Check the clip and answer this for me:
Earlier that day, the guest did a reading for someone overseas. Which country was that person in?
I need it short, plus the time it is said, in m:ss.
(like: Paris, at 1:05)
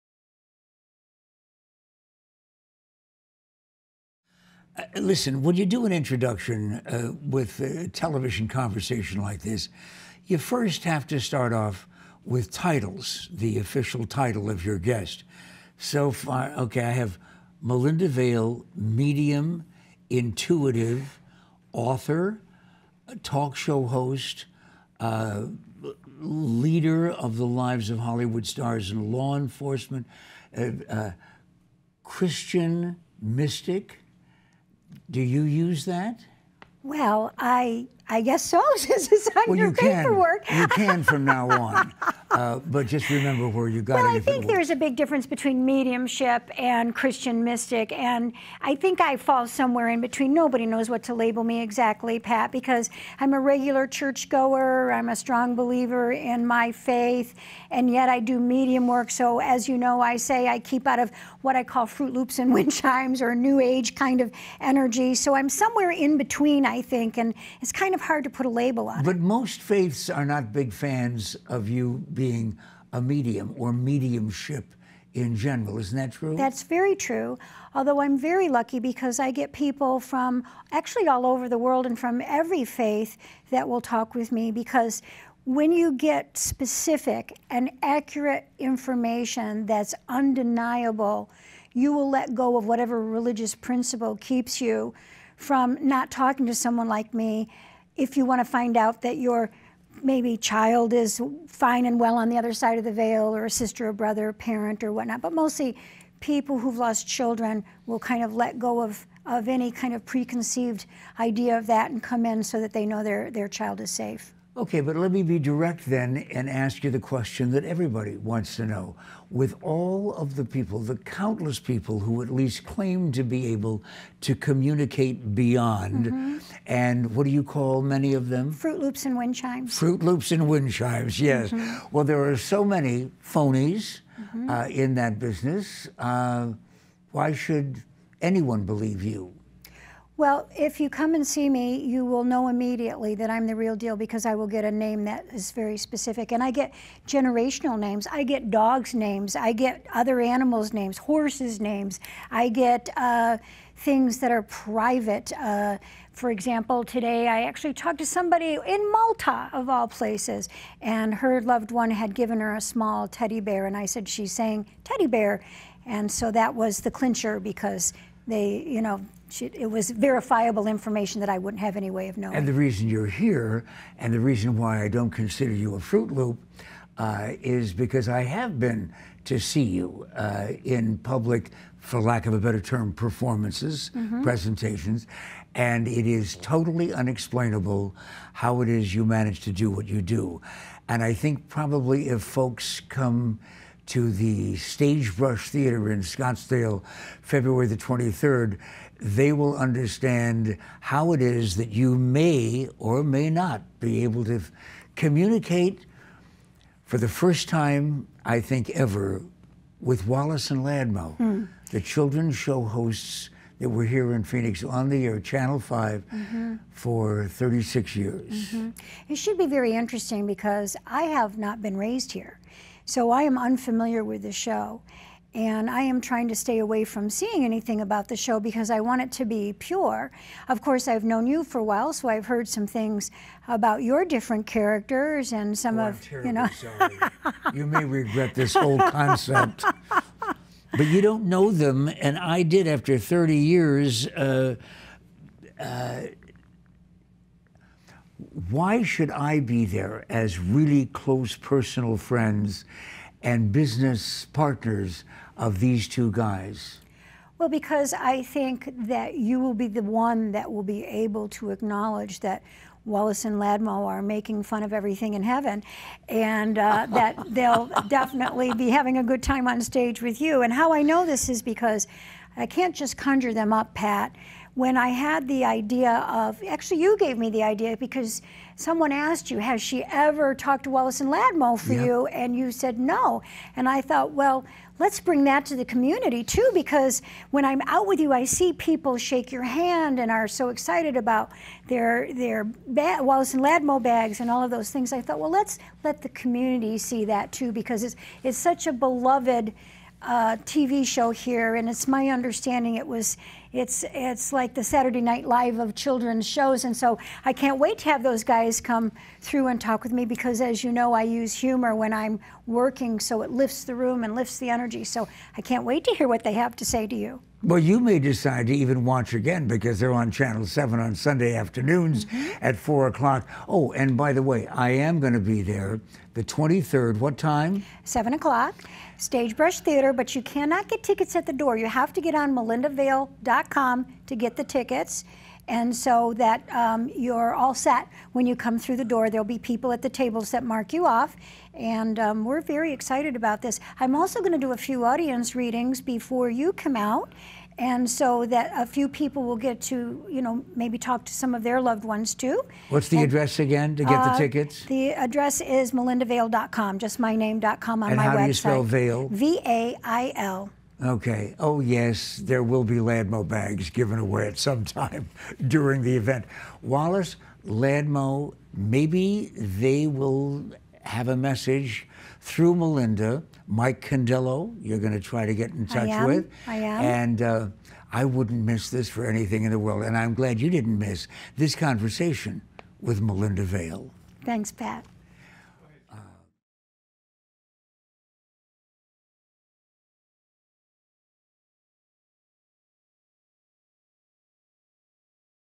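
Malta, at 2:38.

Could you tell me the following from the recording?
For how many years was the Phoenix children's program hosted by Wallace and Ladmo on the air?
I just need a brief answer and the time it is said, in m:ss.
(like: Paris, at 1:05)
36, at 3:37.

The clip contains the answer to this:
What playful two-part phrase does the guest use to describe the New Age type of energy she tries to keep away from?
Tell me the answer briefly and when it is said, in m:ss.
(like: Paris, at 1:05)
Fruit Loops and Wind Chimes, at 1:01.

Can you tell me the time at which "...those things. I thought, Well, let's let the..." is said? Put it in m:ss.
4:54.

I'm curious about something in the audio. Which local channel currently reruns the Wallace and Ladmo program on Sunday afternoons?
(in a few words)
Channel 7.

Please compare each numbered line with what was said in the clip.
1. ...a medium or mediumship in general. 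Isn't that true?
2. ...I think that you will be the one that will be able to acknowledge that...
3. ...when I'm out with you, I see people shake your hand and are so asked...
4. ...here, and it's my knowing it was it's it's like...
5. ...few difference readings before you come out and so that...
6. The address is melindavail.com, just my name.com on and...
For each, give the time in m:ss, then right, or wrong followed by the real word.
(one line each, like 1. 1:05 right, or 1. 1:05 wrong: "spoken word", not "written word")
1. 1:12 right
2. 4:17 right
3. 4:47 wrong: "excited", not "asked"
4. 5:01 wrong: "understanding", not "knowing"
5. 5:44 wrong: "audience", not "difference"
6. 5:54 right.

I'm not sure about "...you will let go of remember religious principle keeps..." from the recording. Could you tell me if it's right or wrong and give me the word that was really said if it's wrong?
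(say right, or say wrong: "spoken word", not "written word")
wrong: "whatever", not "remember".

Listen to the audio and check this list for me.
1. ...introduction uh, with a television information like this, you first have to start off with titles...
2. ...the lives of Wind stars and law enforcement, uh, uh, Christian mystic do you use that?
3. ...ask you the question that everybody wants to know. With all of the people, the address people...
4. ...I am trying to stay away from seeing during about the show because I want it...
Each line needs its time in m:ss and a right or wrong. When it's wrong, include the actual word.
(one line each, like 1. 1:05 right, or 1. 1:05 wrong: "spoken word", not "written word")
1. 0:05 wrong: "conversation", not "information"
2. 0:27 wrong: "Hollywood", not "Wind"
3. 1:56 wrong: "countless", not "address"
4. 3:45 wrong: "anything", not "during".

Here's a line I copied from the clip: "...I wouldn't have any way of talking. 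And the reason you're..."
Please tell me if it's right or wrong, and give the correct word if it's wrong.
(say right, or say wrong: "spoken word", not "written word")
wrong: "knowing", not "talking".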